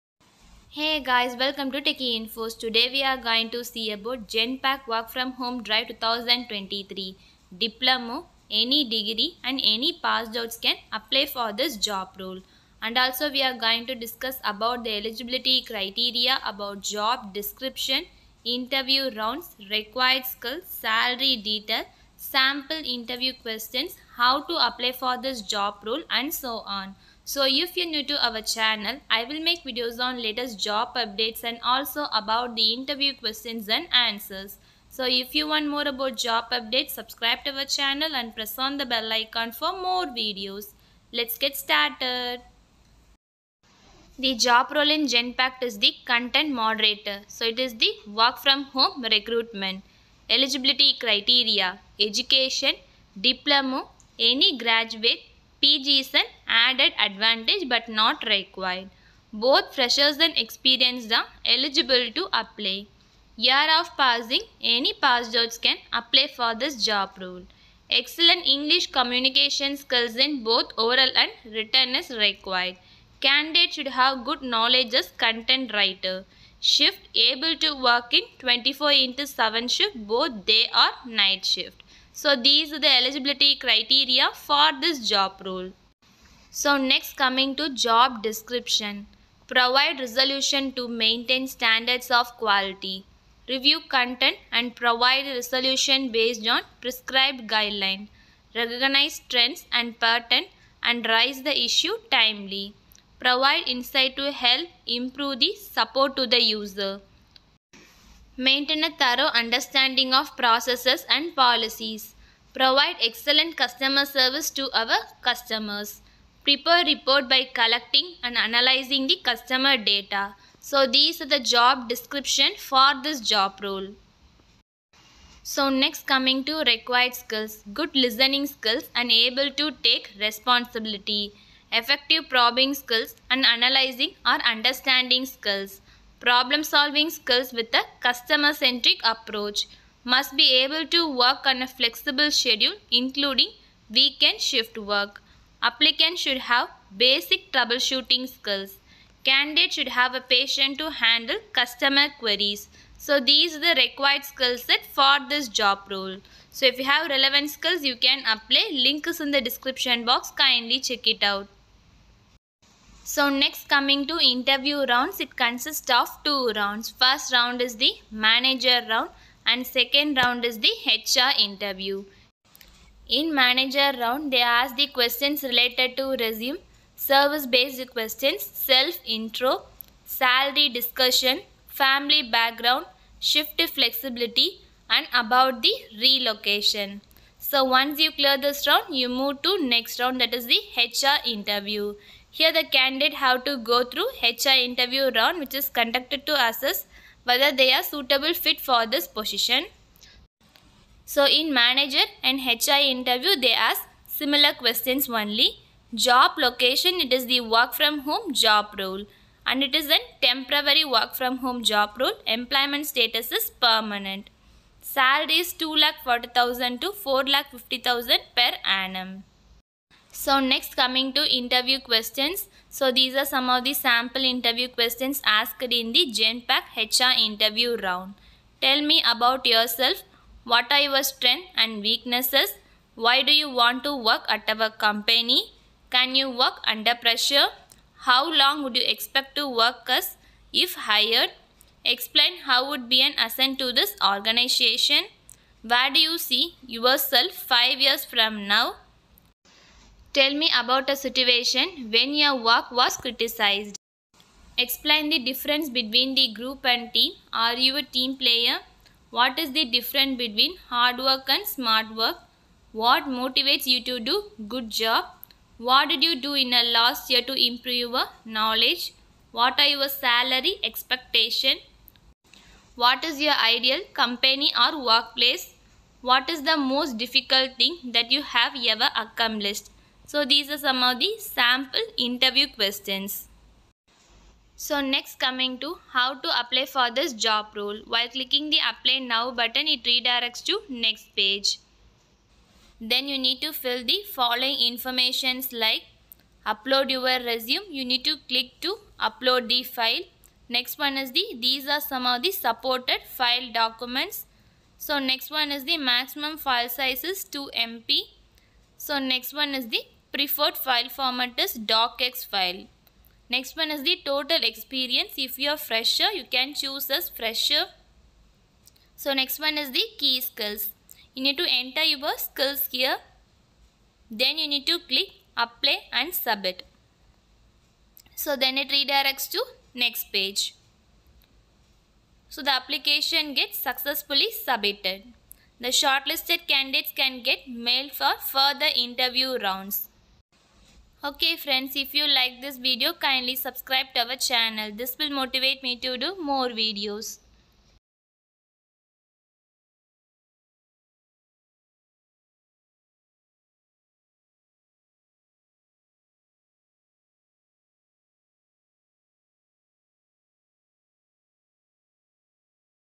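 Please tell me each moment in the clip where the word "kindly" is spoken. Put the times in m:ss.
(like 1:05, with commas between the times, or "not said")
2:40, 5:42.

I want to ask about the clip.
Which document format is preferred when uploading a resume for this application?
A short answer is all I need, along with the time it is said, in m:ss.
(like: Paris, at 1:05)
docx, at 5:11.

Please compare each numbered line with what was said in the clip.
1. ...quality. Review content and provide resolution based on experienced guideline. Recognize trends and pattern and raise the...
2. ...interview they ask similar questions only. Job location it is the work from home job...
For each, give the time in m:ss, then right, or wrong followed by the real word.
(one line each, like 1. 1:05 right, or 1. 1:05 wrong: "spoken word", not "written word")
1. 1:32 wrong: "prescribed", not "experienced"
2. 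3:22 right.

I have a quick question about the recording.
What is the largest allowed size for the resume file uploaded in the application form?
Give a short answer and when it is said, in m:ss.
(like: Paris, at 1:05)
2 MB, at 5:07.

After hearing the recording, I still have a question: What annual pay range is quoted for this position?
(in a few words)
2,40,000 to 4,50,000.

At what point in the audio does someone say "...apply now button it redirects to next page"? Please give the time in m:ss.
4:48.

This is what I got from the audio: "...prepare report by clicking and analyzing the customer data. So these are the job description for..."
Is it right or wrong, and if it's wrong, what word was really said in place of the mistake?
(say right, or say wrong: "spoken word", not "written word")
wrong: "collecting", not "clicking".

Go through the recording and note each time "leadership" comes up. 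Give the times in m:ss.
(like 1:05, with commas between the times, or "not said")
not said.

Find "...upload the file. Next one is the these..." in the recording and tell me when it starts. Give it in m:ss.
4:58.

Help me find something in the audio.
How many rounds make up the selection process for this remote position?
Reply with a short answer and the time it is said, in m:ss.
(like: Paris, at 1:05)
2, at 2:46.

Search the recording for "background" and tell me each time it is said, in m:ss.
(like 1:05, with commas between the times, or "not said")
3:02.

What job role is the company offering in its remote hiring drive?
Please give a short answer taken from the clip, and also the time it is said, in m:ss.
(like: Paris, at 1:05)
Content moderator, at 0:46.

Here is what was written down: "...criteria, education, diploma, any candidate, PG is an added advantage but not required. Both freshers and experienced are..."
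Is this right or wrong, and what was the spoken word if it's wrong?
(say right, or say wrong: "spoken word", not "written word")
wrong: "graduate", not "candidate".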